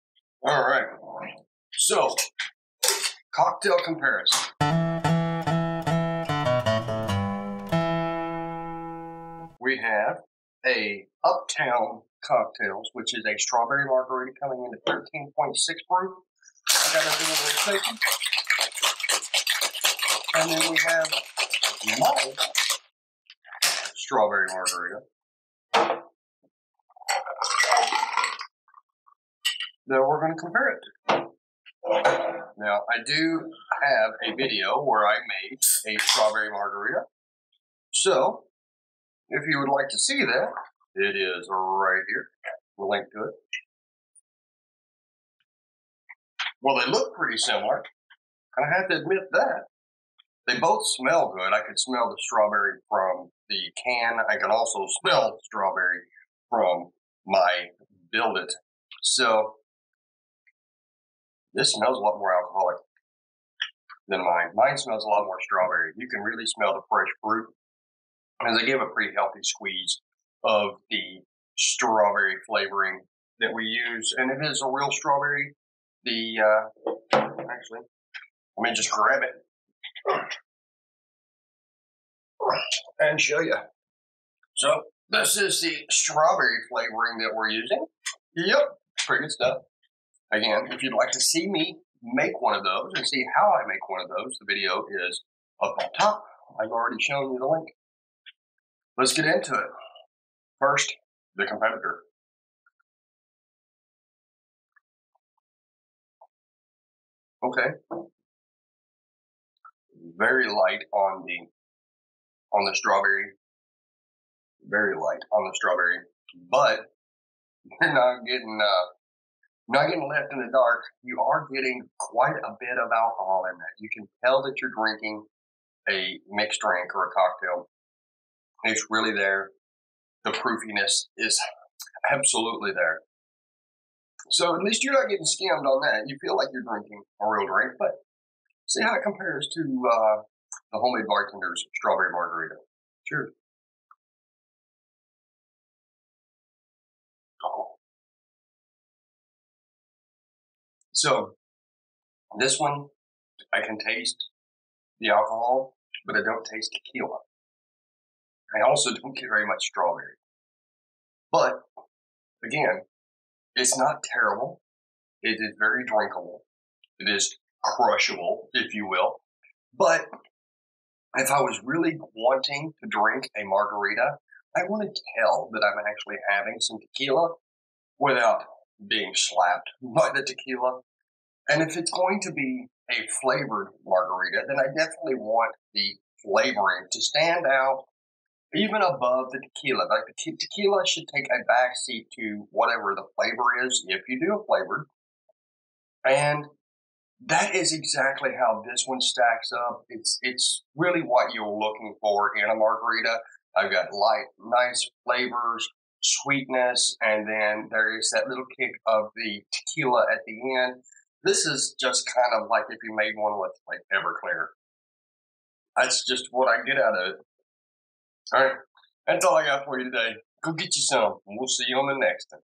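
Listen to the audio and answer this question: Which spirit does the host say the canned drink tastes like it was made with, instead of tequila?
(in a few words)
Everclear.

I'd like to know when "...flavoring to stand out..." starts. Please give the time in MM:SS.
03:06.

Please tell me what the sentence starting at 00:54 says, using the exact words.
I can also smell strawberry from my build it.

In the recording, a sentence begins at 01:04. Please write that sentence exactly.
Mine smells a lot more strawberry.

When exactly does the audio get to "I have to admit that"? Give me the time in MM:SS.
00:48.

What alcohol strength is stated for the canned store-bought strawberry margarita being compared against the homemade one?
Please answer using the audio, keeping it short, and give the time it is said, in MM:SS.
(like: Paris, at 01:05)
13.6 proof, at 00:14.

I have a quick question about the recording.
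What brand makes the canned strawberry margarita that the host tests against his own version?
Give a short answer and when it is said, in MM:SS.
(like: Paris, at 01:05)
Uptown Cocktails, at 00:11.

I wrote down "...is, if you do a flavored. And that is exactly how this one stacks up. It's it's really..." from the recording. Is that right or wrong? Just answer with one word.
right.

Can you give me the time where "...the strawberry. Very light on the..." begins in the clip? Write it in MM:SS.
01:52.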